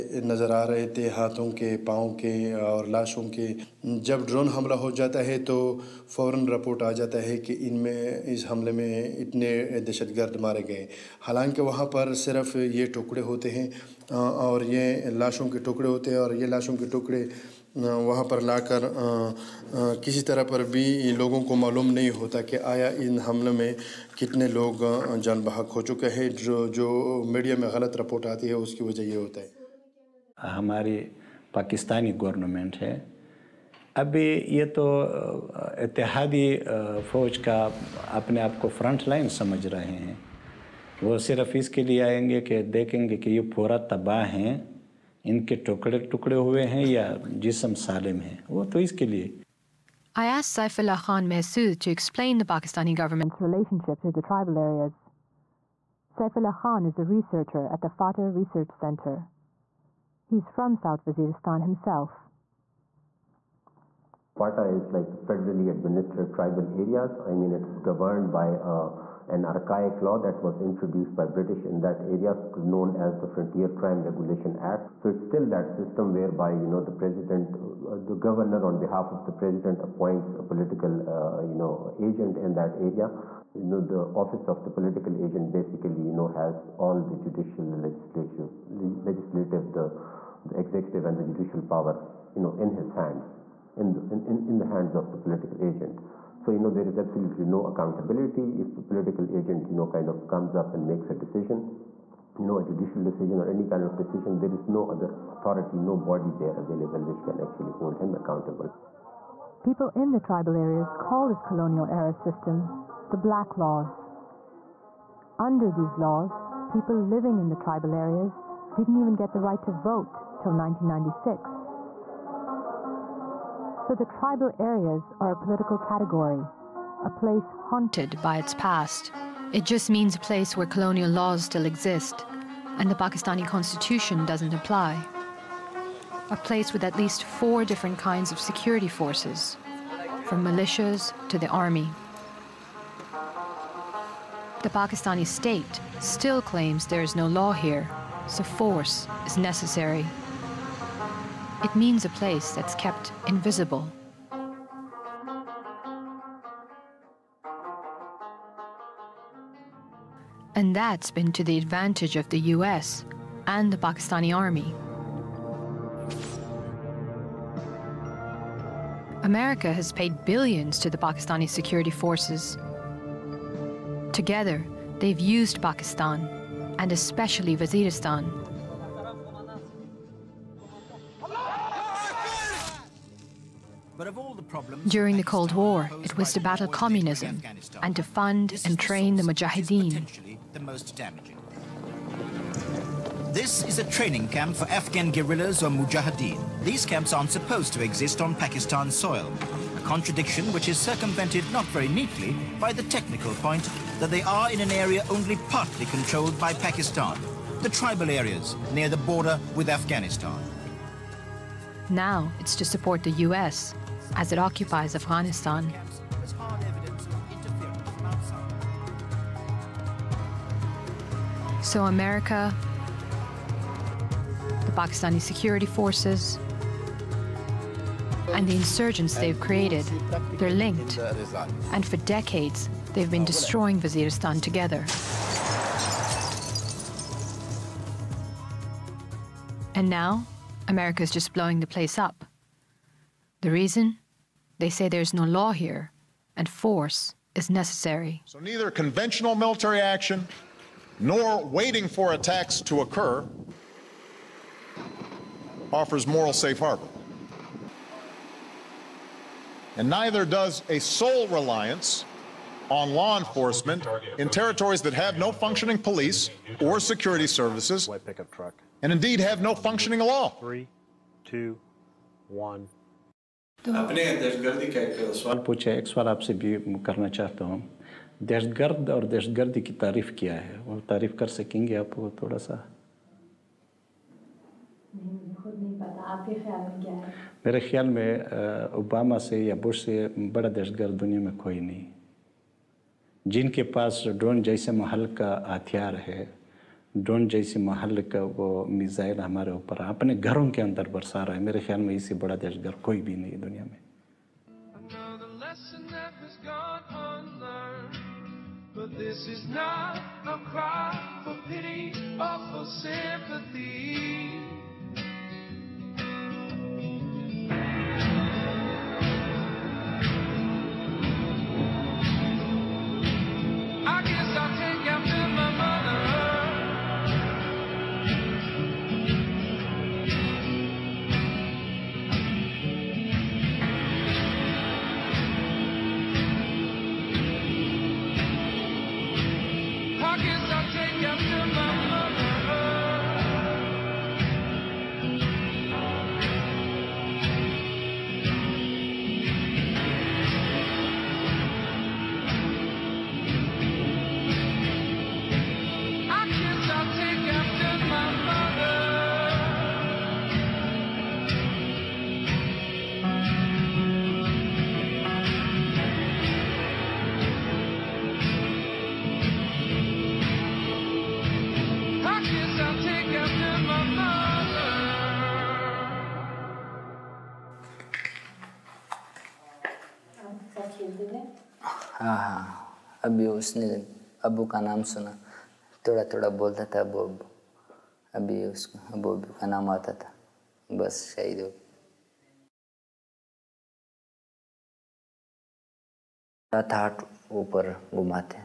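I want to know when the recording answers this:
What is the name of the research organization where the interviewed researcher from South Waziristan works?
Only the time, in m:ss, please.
0:57.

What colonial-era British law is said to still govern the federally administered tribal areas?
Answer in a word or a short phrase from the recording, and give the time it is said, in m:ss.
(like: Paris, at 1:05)
Frontier Crime Regulation Act, at 1:13.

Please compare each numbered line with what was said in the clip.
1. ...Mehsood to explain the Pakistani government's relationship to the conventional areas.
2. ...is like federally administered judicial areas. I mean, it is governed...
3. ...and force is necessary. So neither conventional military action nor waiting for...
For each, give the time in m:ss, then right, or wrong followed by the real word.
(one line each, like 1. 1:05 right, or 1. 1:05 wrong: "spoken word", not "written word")
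1. 0:51 wrong: "tribal", not "conventional"
2. 1:04 wrong: "tribal", not "judicial"
3. 4:06 right.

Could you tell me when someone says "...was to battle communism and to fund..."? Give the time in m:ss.
3:06.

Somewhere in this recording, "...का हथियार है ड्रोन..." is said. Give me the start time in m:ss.
4:55.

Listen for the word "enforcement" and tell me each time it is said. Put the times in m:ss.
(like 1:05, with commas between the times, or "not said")
4:23.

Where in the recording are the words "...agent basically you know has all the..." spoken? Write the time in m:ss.
1:25.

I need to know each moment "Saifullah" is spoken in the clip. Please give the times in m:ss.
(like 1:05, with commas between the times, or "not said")
0:50, 0:56.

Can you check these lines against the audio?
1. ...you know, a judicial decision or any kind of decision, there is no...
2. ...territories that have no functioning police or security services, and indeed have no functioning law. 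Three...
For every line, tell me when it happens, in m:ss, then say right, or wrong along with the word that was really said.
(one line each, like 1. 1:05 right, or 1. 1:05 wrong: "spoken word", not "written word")
1. 1:42 right
2. 4:24 right.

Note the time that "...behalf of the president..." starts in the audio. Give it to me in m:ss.
1:18.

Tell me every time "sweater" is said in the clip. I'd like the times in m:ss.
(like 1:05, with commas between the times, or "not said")
not said.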